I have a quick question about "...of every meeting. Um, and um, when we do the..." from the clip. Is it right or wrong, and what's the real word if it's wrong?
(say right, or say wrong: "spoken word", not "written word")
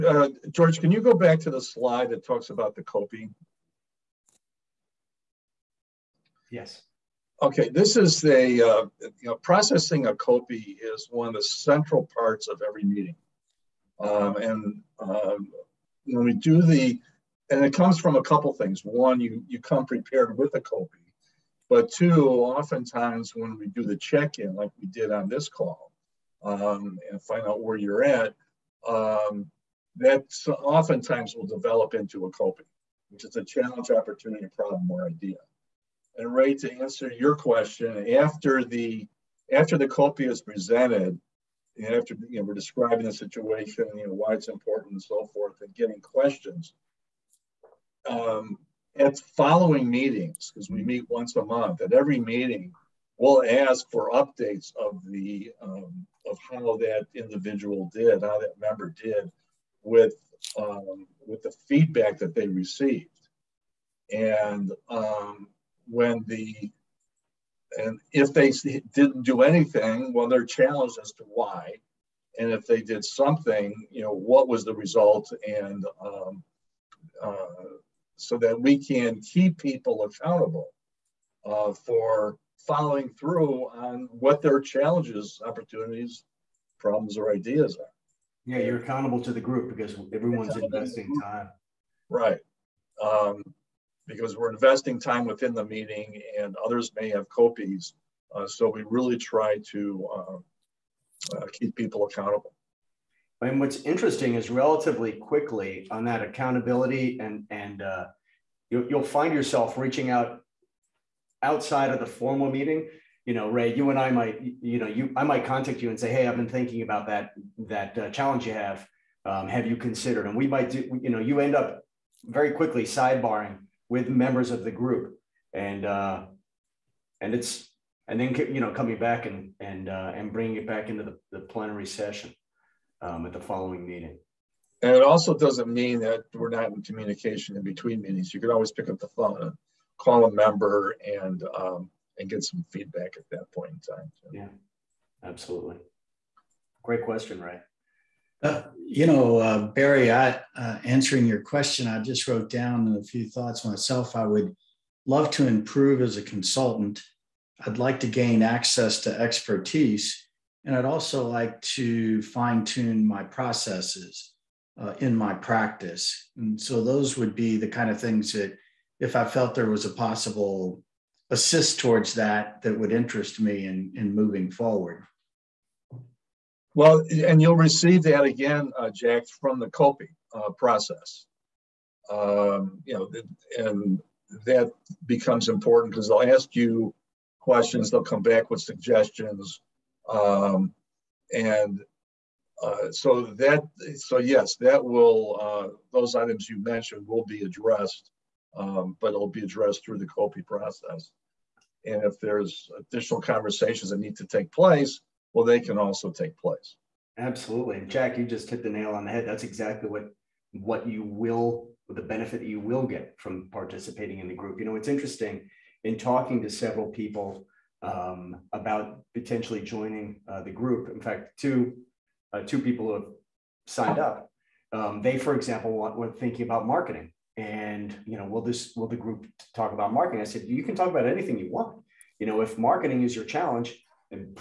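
right.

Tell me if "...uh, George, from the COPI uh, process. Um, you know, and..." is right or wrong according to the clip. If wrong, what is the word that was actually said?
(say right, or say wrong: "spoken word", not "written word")
wrong: "Jack", not "George".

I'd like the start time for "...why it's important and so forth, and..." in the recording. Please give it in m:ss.
0:44.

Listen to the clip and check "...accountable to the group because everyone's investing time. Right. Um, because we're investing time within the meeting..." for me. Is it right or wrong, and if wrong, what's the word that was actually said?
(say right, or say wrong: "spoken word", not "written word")
right.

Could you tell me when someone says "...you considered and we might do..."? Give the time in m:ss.
1:59.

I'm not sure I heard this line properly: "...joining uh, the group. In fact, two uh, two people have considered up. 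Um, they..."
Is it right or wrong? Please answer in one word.
wrong.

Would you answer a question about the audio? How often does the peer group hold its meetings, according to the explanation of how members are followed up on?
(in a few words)
Once a month.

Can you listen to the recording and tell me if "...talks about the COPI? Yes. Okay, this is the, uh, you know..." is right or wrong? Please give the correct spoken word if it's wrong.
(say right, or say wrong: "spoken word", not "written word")
right.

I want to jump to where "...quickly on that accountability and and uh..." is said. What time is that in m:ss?
1:45.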